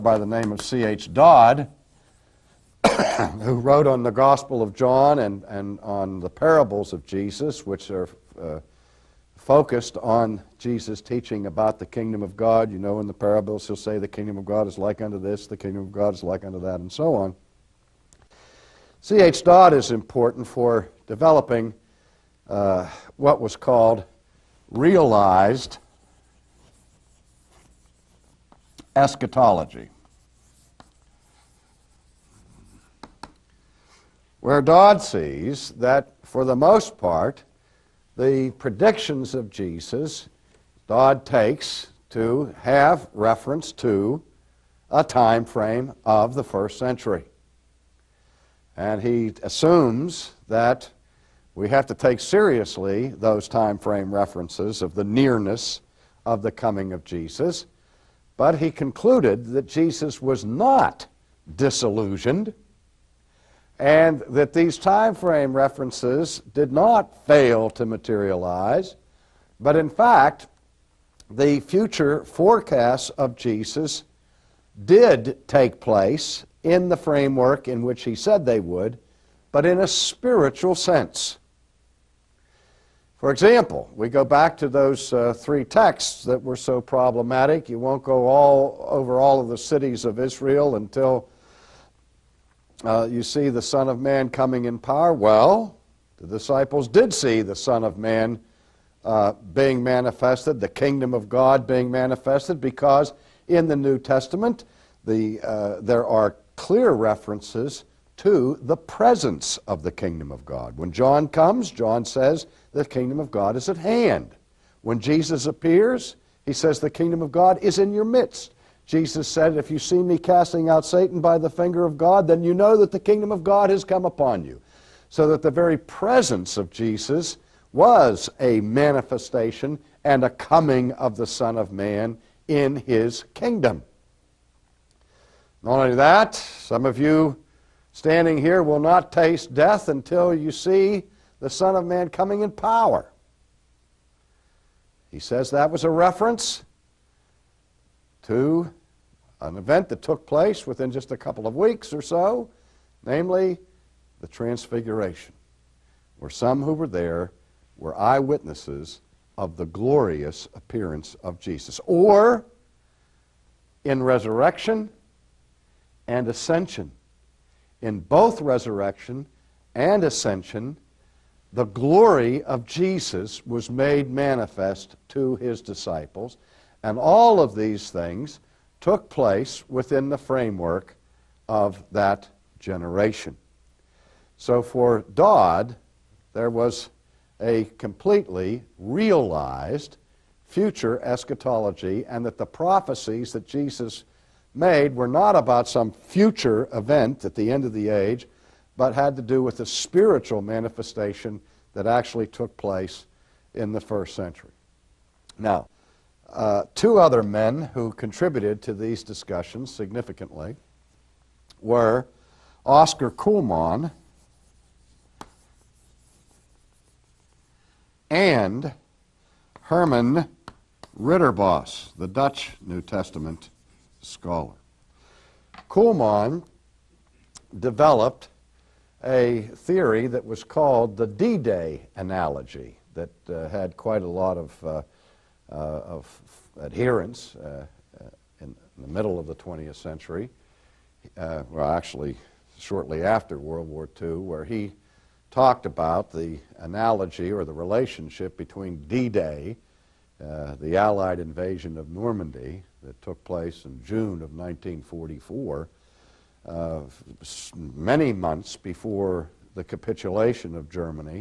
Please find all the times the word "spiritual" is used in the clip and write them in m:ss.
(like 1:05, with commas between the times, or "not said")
1:19, 3:19.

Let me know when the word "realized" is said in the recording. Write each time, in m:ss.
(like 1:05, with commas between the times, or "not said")
0:24, 3:08.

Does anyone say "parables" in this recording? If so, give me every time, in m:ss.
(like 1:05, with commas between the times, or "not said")
0:06, 0:13.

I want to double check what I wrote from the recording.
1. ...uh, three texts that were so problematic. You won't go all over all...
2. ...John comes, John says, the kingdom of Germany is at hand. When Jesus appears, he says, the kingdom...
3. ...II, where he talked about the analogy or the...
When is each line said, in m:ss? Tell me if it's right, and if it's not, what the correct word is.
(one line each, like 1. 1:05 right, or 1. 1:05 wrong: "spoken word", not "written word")
1. 1:25 right
2. 1:50 wrong: "God", not "Germany"
3. 4:03 right.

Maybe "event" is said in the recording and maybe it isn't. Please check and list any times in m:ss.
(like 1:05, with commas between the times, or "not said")
2:29, 3:16.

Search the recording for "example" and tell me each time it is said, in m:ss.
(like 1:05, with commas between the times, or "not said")
1:23.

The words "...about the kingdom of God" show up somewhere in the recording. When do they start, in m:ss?
0:11.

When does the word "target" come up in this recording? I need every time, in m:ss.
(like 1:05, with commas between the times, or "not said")
not said.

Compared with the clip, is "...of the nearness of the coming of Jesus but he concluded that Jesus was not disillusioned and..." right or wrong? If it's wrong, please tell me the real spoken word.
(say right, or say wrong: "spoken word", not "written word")
right.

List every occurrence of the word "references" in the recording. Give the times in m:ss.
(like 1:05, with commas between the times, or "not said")
0:43, 0:54, 1:05, 1:46, 2:25.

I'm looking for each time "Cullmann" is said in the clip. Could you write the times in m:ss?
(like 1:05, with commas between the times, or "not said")
3:33, 3:45.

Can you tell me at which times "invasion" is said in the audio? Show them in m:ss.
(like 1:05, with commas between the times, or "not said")
4:11.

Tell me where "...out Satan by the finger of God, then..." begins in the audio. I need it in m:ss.
2:00.